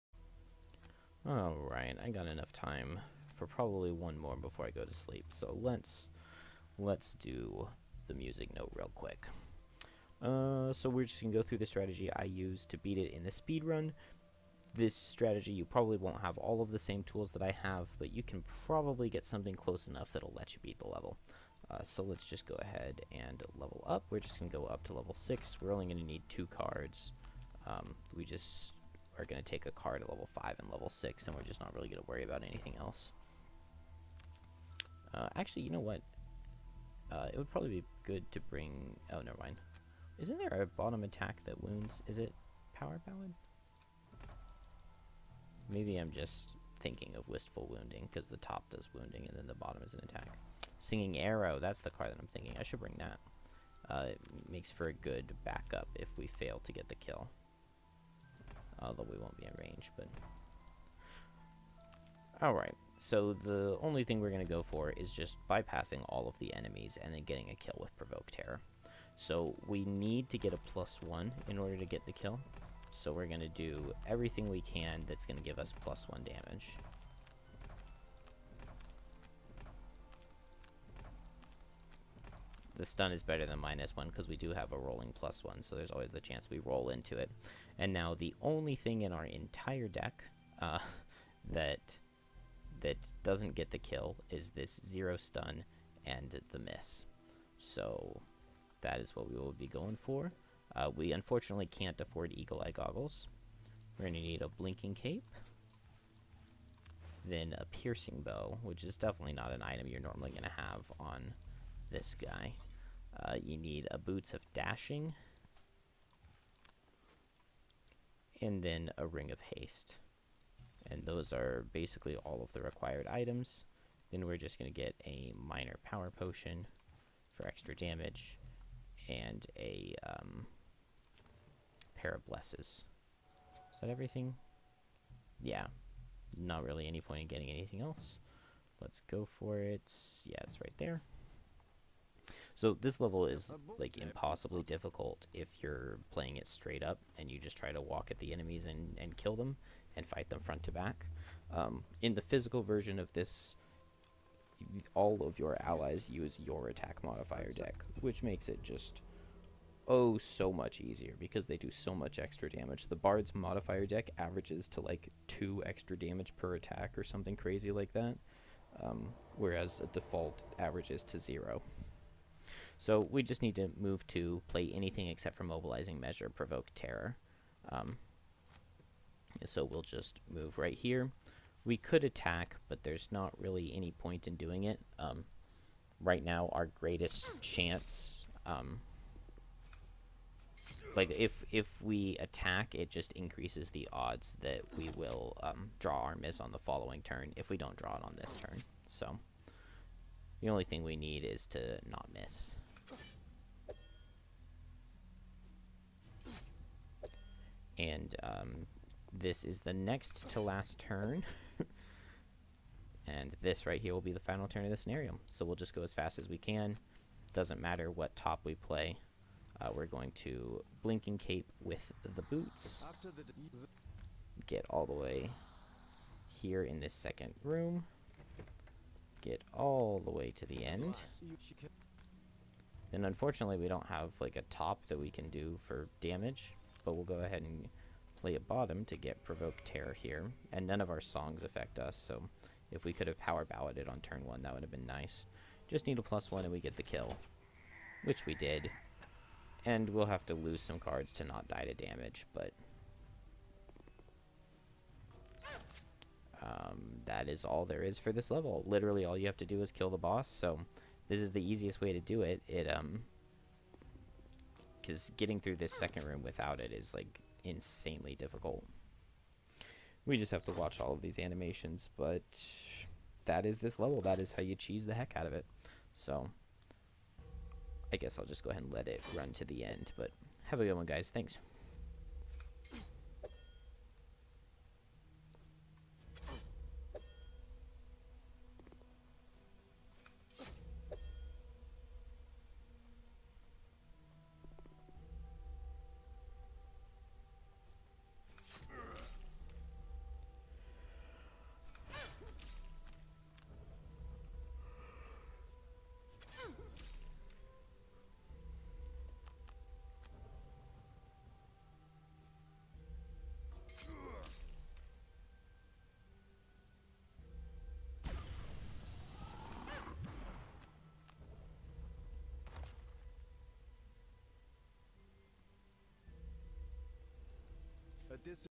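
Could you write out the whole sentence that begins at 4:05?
Just need a plus 1 and we get the kill, which we did.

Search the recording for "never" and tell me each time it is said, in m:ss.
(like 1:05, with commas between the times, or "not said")
0:39.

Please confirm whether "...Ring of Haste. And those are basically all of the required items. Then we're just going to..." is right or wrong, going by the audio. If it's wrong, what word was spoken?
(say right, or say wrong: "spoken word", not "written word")
right.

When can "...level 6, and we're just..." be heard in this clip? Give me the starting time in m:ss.
0:30.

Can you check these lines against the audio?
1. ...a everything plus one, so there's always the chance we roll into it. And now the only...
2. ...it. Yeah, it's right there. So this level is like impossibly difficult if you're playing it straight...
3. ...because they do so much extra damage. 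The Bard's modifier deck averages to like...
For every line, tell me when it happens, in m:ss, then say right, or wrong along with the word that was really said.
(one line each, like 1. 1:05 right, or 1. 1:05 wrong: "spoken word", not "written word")
1. 1:24 wrong: "rolling", not "everything"
2. 2:19 right
3. 2:41 right.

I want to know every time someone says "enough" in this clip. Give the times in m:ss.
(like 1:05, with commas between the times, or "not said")
0:02, 0:19.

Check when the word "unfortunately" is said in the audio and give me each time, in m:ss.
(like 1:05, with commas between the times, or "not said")
1:41, 3:53.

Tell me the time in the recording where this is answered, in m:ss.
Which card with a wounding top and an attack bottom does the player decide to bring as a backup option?
0:50.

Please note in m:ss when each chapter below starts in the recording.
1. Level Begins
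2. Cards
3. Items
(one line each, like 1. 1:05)
1. 2:50
2. 0:23
3. 1:42.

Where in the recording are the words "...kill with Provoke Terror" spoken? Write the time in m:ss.
1:07.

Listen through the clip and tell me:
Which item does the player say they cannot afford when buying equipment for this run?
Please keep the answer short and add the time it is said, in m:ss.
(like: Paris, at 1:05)
Eagle Eye Goggles, at 1:42.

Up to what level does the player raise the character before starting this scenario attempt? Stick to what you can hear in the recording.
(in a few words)
6.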